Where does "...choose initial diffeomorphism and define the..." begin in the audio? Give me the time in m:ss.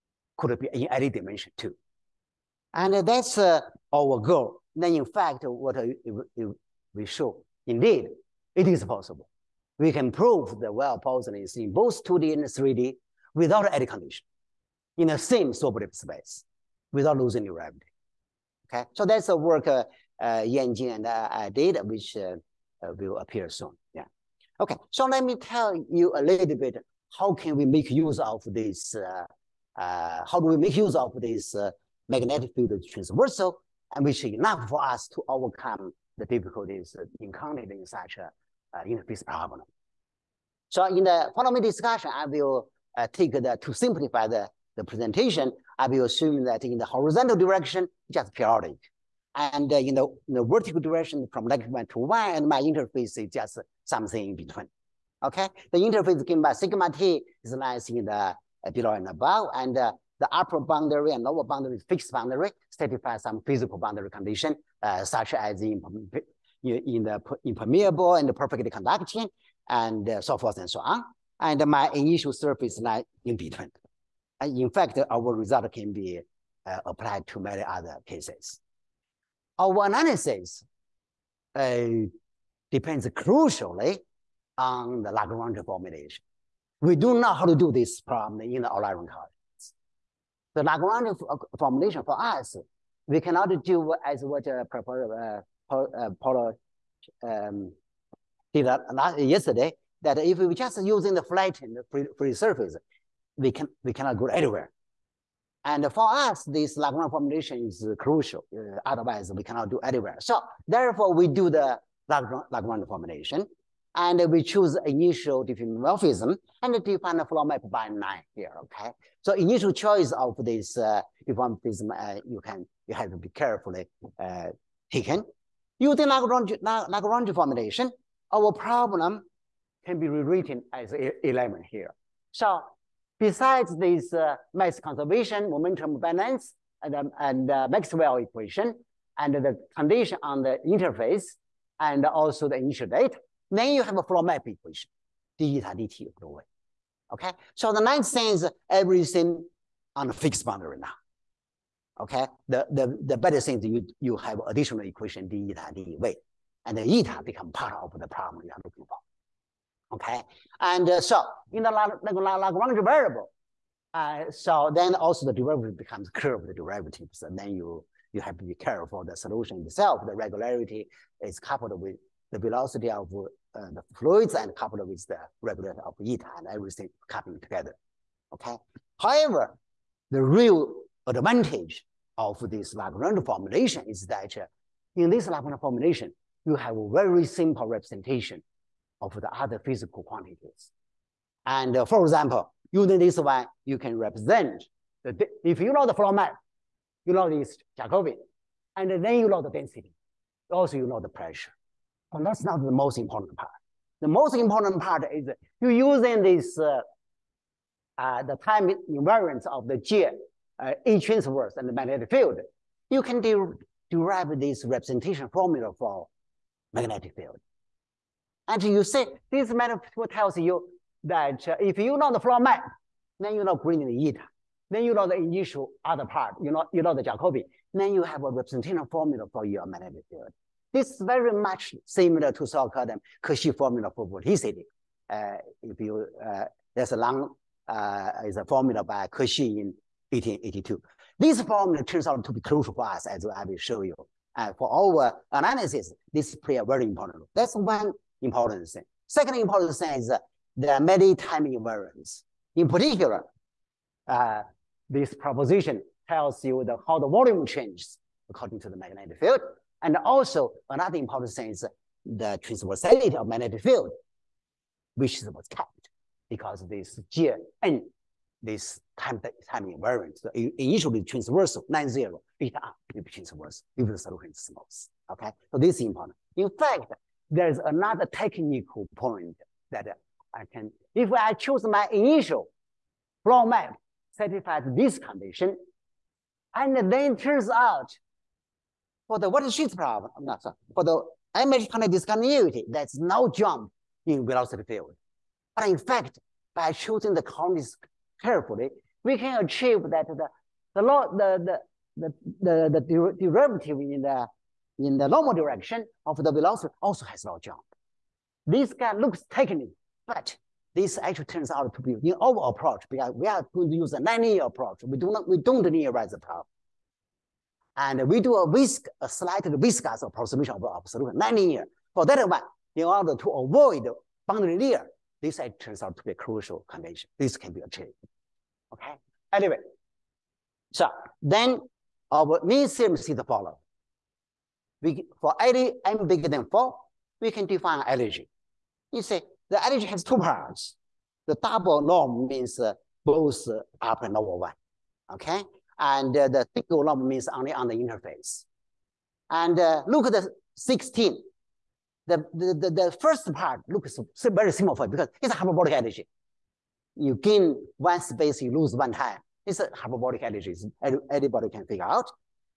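1:54.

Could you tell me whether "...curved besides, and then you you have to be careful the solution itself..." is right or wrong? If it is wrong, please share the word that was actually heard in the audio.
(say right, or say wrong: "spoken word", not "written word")
wrong: "derivatives", not "besides".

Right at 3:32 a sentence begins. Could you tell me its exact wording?
You can de derive this representation formula for magnetic field.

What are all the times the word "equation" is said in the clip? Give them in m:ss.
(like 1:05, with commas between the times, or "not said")
2:18, 2:24, 2:34.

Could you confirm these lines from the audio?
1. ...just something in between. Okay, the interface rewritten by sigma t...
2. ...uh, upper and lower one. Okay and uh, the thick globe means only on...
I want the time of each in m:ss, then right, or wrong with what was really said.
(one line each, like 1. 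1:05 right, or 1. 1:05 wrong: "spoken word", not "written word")
1. 0:53 wrong: "given", not "rewritten"
2. 5:43 right.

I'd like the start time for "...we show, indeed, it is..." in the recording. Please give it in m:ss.
0:06.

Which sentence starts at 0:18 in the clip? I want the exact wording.
Okay, so that's the work uh, uh, Yanjin and I, uh, I uh, did, which uh, uh, will appear soon.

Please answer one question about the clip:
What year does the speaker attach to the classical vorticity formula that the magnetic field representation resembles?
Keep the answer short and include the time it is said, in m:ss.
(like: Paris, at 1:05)
1882, at 4:00.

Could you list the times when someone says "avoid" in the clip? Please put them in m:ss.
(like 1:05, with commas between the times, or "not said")
5:23.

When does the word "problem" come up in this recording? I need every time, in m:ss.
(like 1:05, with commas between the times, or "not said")
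0:39, 1:27, 2:08, 2:38, 4:49, 5:16.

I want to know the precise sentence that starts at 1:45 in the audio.
And for us, this Lagrange formulation is crucial.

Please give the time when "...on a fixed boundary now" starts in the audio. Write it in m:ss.
2:29.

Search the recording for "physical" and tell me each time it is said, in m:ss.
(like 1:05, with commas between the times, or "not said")
1:03, 3:09.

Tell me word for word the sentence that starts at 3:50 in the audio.
This is very much similar to so-called Cauchy formula for vorticity.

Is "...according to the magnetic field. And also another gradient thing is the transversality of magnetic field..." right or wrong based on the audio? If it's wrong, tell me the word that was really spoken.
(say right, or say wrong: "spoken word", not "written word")
wrong: "important", not "gradient".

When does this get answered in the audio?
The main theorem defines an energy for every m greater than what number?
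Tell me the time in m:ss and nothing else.
5:36.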